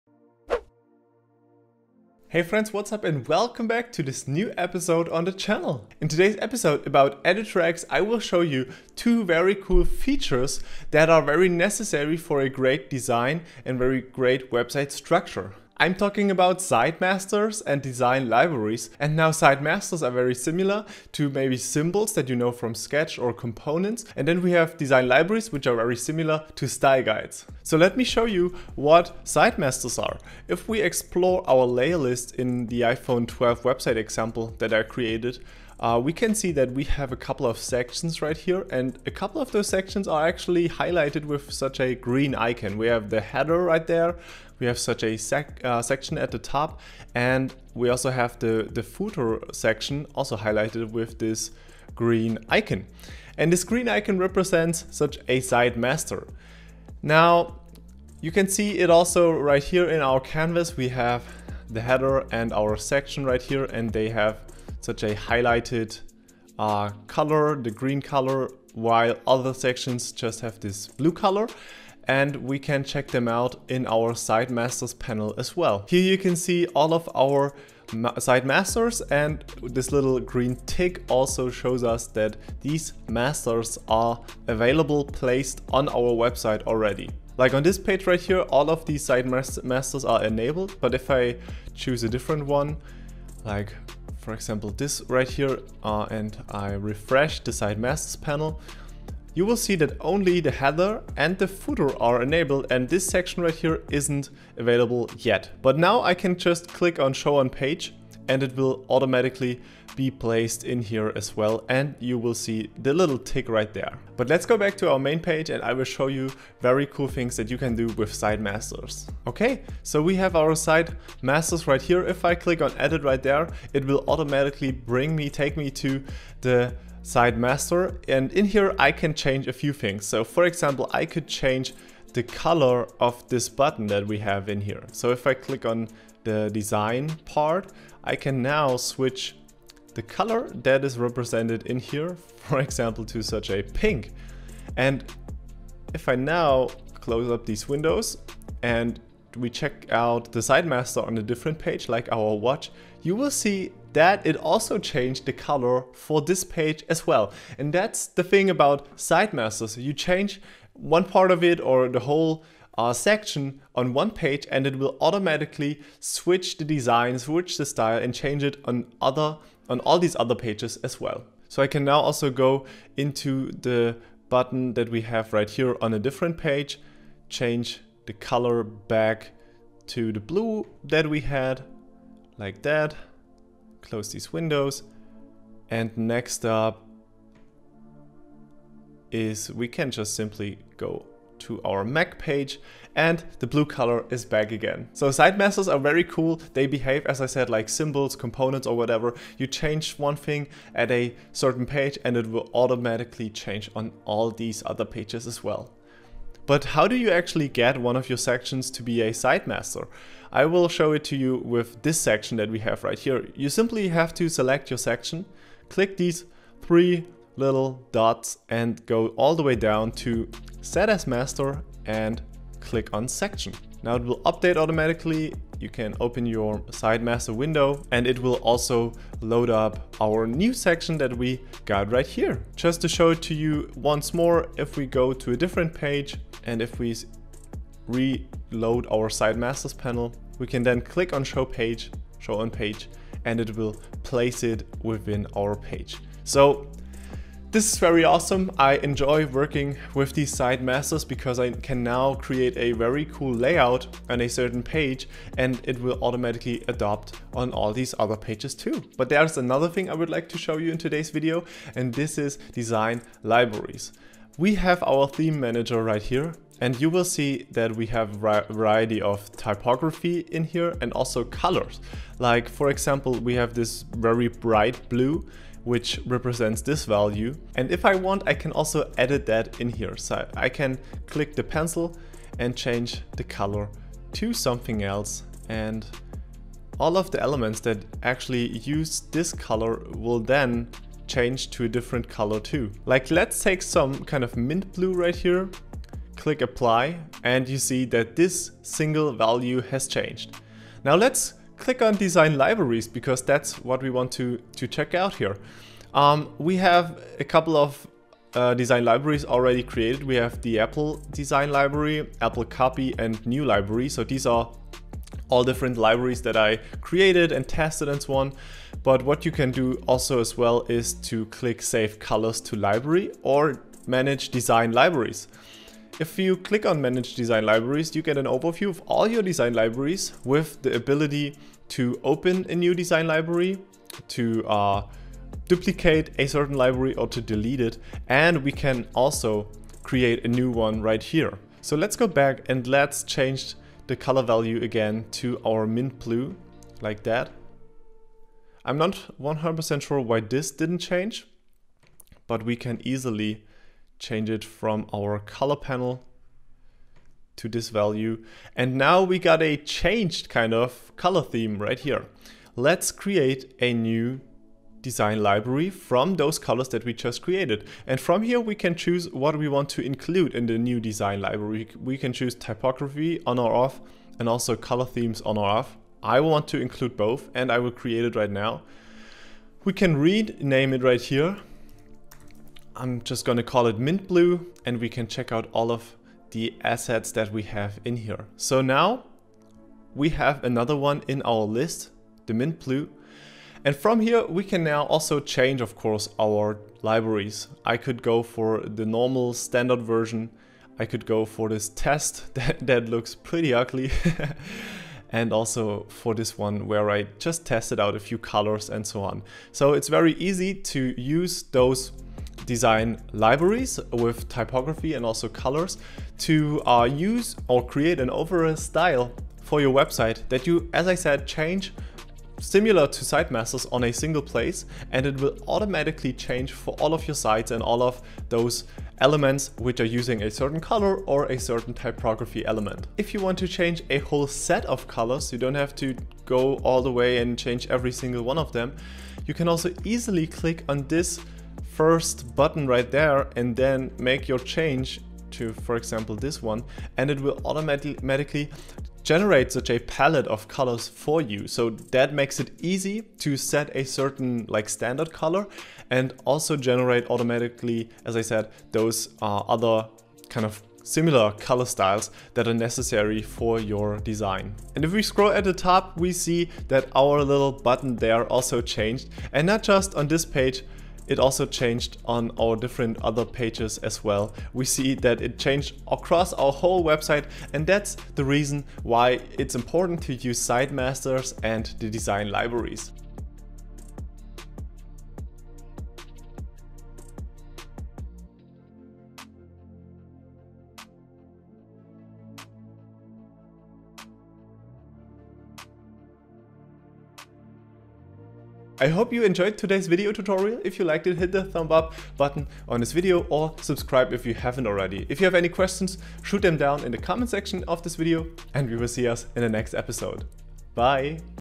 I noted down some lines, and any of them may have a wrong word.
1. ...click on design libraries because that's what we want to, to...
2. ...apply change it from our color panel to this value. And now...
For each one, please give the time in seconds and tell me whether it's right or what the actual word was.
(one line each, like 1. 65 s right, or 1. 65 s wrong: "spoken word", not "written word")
1. 301 s right
2. 352 s wrong: "easily", not "apply".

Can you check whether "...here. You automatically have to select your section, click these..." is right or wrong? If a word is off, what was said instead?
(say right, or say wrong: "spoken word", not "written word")
wrong: "simply", not "automatically".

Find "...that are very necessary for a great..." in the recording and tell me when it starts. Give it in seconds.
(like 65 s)
10 s.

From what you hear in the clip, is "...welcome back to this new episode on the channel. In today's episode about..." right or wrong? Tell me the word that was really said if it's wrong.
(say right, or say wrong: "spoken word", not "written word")
right.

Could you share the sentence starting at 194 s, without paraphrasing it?
So site masters are very cool.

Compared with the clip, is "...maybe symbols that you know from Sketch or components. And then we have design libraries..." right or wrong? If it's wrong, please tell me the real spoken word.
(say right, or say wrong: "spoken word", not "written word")
right.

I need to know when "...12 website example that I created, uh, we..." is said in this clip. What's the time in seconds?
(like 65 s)
33 s.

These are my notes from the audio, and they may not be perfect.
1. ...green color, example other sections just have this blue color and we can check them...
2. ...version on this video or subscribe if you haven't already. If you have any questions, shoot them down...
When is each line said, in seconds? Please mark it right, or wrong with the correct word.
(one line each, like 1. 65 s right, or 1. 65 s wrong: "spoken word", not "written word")
1. 67 s wrong: "while", not "example"
2. 502 s wrong: "button", not "version".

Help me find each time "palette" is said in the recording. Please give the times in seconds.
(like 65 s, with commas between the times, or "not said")
449 s.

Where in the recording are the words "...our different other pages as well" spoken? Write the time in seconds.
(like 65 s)
472 s.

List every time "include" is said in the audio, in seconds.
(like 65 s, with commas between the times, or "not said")
369 s, 376 s.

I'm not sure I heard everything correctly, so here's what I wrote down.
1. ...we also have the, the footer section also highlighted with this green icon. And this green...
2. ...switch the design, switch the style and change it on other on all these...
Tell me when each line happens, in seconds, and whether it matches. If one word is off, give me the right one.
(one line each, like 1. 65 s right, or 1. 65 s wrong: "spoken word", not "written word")
1. 47 s right
2. 165 s right.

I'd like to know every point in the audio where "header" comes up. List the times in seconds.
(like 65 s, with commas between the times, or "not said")
43 s, 61 s, 100 s.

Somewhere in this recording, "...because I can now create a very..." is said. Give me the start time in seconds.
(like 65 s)
251 s.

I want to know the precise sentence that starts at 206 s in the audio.
But how do you actually get one of your sections to be a site master?